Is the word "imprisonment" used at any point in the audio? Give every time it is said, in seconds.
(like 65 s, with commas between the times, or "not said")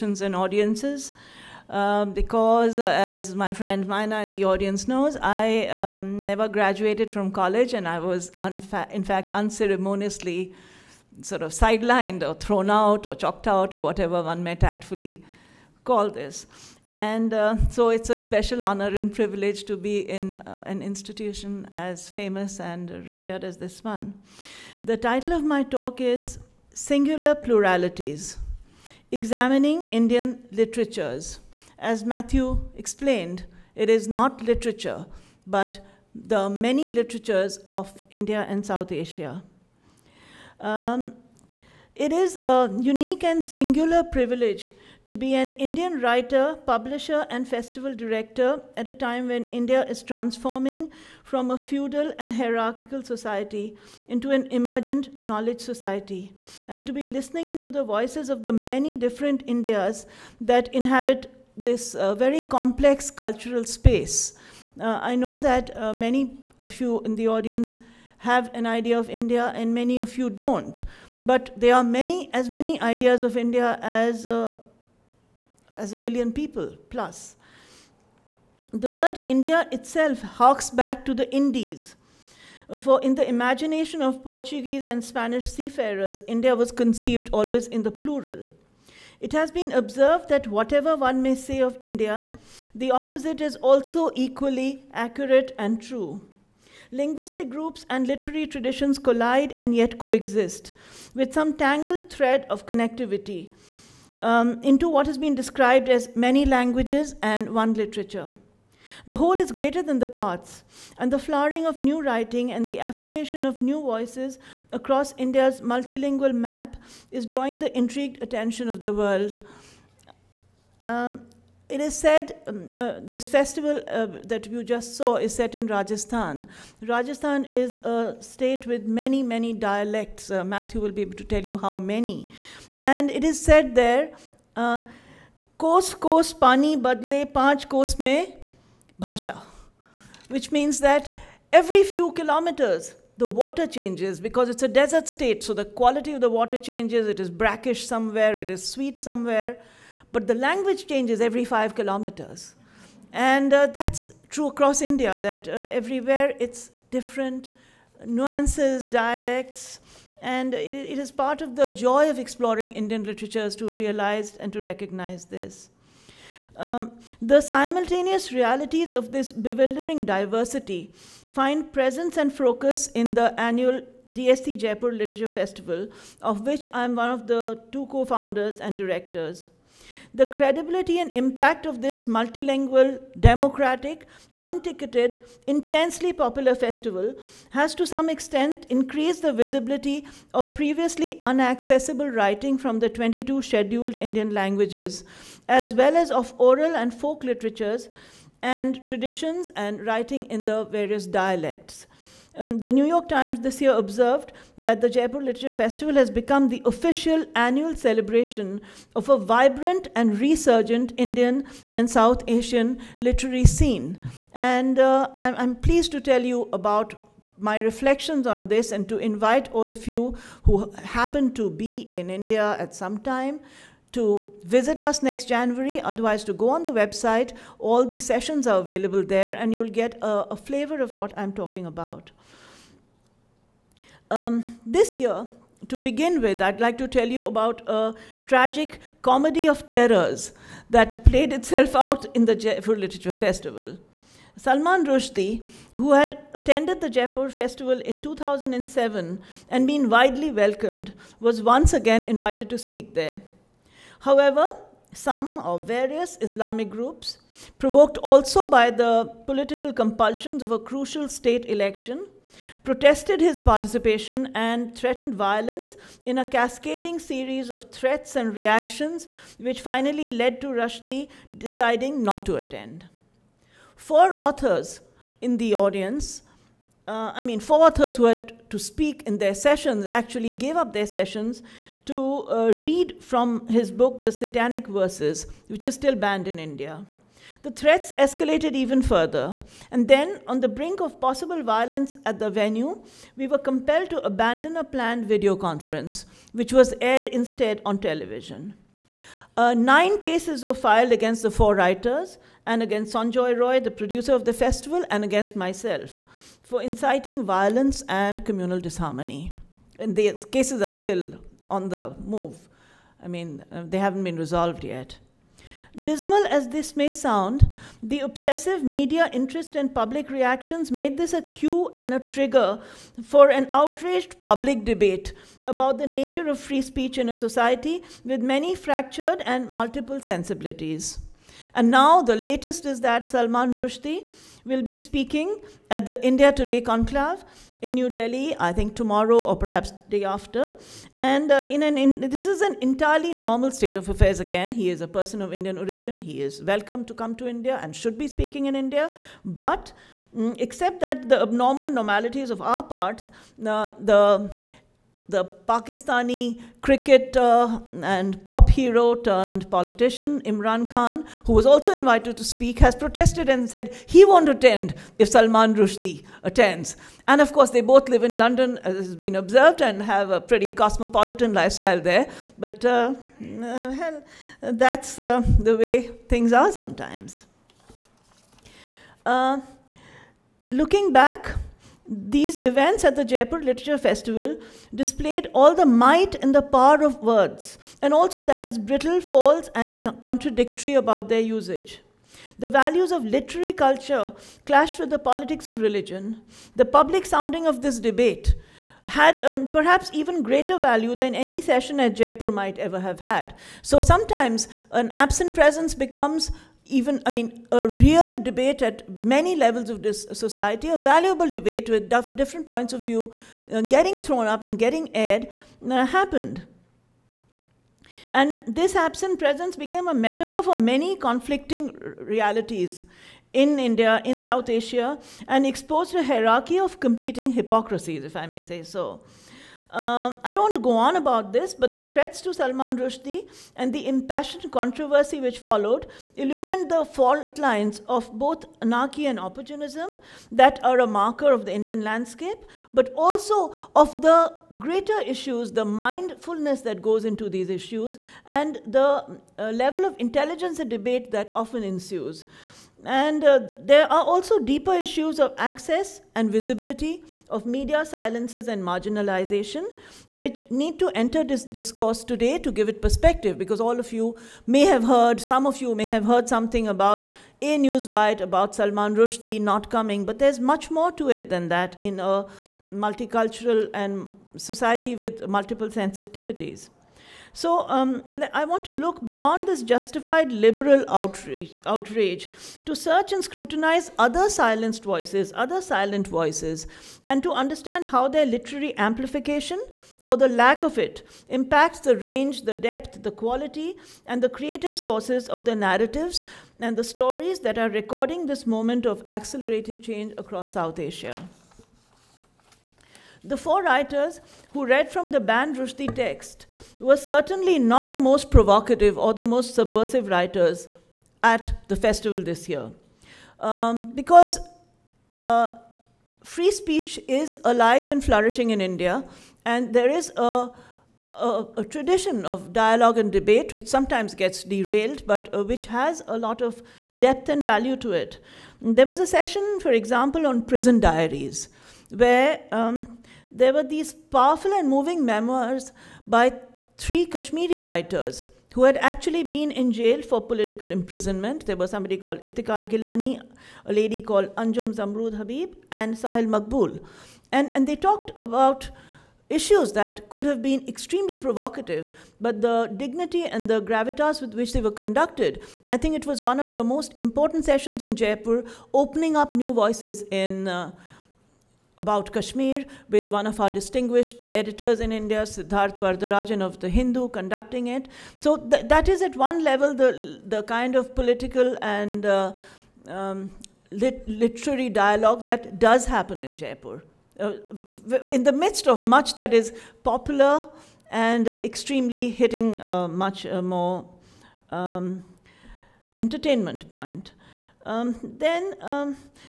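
540 s.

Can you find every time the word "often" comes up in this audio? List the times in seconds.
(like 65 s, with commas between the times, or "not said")
451 s.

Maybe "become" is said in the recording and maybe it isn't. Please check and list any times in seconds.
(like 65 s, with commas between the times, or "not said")
206 s, 405 s.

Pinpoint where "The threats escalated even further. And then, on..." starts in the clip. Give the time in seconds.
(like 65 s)
287 s.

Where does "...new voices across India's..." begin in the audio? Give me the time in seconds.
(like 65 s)
113 s.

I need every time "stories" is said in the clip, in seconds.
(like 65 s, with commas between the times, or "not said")
496 s.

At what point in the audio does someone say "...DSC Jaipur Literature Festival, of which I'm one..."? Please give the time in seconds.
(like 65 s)
174 s.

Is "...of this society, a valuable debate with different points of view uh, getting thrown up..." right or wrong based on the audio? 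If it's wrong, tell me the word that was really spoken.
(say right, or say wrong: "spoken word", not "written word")
right.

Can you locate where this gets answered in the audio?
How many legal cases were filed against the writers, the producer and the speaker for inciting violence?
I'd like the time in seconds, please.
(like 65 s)
299 s.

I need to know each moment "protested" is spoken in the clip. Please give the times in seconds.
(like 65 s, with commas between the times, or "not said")
262 s, 362 s.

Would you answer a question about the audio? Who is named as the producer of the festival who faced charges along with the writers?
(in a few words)
Sanjoy Roy.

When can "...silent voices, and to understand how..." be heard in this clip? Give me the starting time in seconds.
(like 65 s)
485 s.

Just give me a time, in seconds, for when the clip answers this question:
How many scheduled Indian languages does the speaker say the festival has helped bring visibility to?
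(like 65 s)
192 s.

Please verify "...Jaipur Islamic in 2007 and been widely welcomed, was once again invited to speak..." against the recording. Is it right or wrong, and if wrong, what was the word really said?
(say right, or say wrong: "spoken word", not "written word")
wrong: "Festival", not "Islamic".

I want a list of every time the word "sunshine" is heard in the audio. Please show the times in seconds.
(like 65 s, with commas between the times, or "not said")
not said.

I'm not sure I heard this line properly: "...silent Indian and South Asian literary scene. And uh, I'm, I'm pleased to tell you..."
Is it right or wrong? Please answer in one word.
wrong.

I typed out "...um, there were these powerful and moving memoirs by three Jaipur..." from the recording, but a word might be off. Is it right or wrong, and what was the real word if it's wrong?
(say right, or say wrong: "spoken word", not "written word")
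wrong: "Kashmiri", not "Jaipur".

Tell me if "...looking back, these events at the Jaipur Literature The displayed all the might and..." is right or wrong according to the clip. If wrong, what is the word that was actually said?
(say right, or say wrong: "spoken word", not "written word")
wrong: "Festival", not "The".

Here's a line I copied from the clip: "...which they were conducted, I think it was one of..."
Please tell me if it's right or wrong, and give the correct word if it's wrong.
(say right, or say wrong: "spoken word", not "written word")
right.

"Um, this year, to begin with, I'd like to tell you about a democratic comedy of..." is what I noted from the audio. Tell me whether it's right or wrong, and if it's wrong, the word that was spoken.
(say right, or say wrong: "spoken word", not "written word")
wrong: "tragic", not "democratic".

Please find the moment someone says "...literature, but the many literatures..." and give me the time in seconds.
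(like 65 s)
34 s.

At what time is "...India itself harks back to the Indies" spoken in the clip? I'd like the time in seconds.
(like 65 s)
79 s.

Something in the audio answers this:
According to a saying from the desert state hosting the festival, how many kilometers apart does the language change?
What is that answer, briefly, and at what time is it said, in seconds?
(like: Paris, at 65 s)
5, at 151 s.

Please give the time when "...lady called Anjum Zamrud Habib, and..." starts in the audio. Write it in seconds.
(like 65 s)
543 s.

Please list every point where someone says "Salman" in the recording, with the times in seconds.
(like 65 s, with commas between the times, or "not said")
244 s, 333 s, 365 s, 432 s, 468 s.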